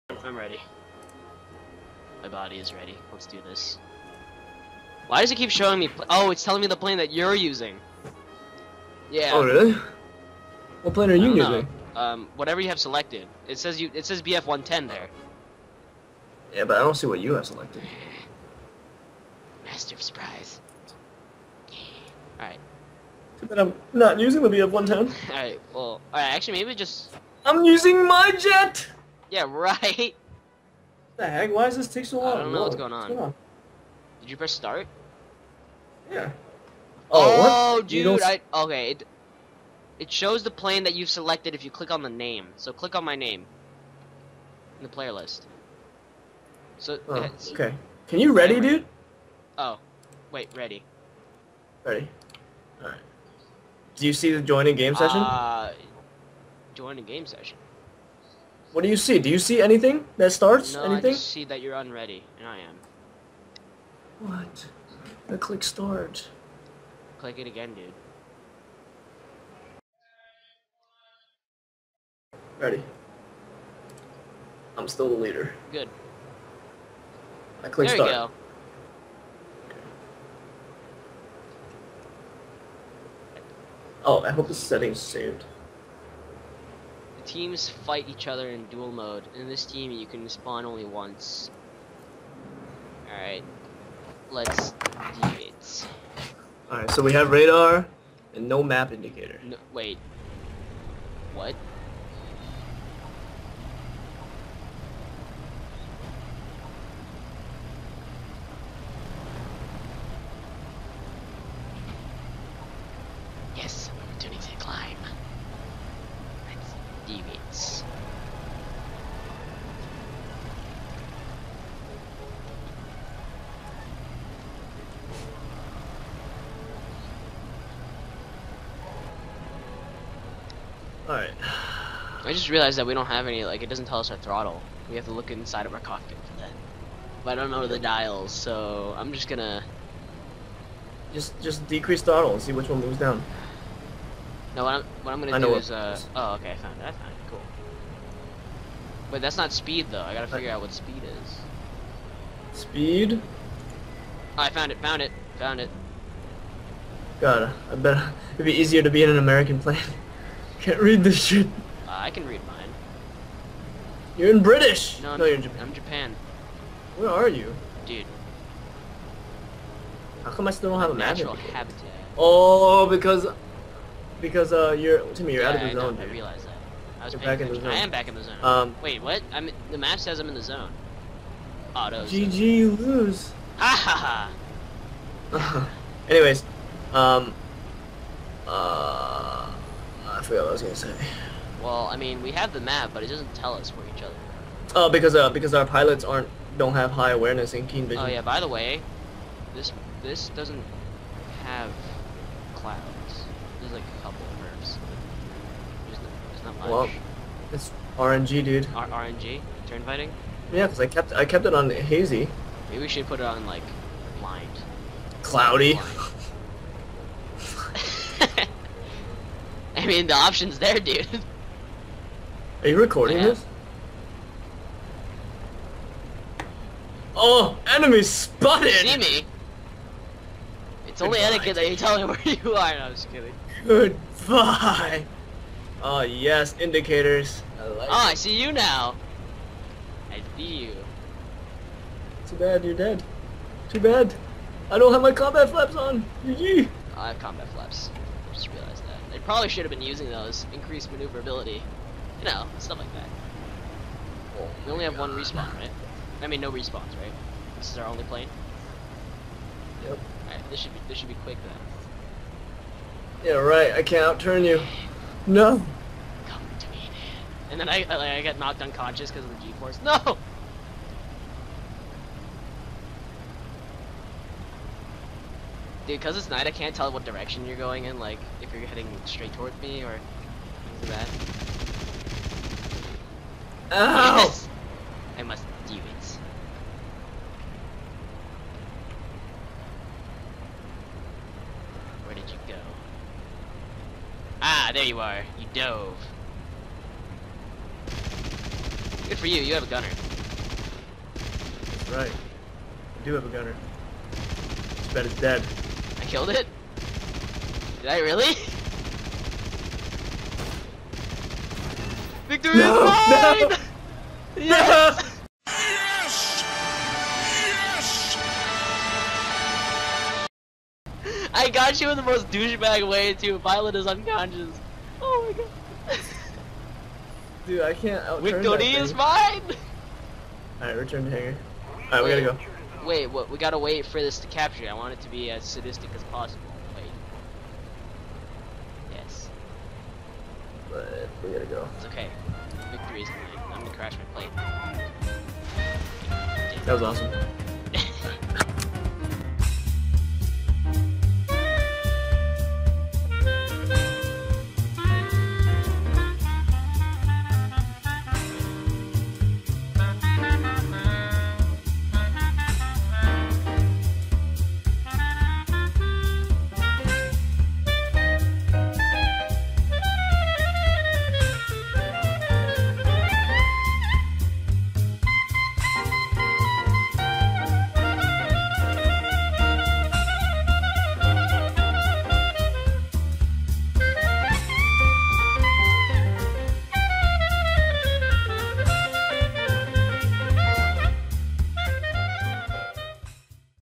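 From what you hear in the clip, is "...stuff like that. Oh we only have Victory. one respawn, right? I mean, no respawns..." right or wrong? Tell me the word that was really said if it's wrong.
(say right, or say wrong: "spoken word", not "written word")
wrong: "God", not "Victory".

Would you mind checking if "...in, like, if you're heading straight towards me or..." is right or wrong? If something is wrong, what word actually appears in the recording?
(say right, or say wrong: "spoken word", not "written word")
right.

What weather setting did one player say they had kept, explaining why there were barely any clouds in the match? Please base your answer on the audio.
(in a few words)
hazy.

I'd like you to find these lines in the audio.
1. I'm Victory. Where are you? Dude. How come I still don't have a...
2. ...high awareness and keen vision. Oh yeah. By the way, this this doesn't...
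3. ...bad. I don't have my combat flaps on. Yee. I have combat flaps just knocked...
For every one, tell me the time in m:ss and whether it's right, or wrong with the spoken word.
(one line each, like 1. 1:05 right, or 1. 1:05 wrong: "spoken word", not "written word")
1. 2:45 wrong: "Japan", not "Victory"
2. 3:16 right
3. 4:03 wrong: "realized", not "knocked".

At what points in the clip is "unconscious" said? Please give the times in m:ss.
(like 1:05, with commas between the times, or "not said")
4:28, 5:23.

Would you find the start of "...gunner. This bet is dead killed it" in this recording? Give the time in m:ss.
5:03.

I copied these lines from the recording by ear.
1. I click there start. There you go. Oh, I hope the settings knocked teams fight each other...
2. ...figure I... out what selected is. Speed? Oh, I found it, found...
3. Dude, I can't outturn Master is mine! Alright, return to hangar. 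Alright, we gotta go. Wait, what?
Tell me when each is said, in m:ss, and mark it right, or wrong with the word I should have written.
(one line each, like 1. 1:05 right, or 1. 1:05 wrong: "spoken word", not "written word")
1. 1:17 wrong: "saved", not "knocked"
2. 2:30 wrong: "speed", not "selected"
3. 5:27 wrong: "Victory", not "Master".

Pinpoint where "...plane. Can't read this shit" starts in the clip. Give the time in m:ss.
2:39.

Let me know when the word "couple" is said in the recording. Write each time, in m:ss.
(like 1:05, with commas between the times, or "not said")
3:24.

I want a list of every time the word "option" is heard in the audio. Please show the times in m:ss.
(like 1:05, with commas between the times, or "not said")
3:40.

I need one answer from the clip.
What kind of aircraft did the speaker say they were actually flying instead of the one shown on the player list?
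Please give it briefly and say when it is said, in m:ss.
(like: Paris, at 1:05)
jet, at 0:28.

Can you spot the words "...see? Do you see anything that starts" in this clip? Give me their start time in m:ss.
0:58.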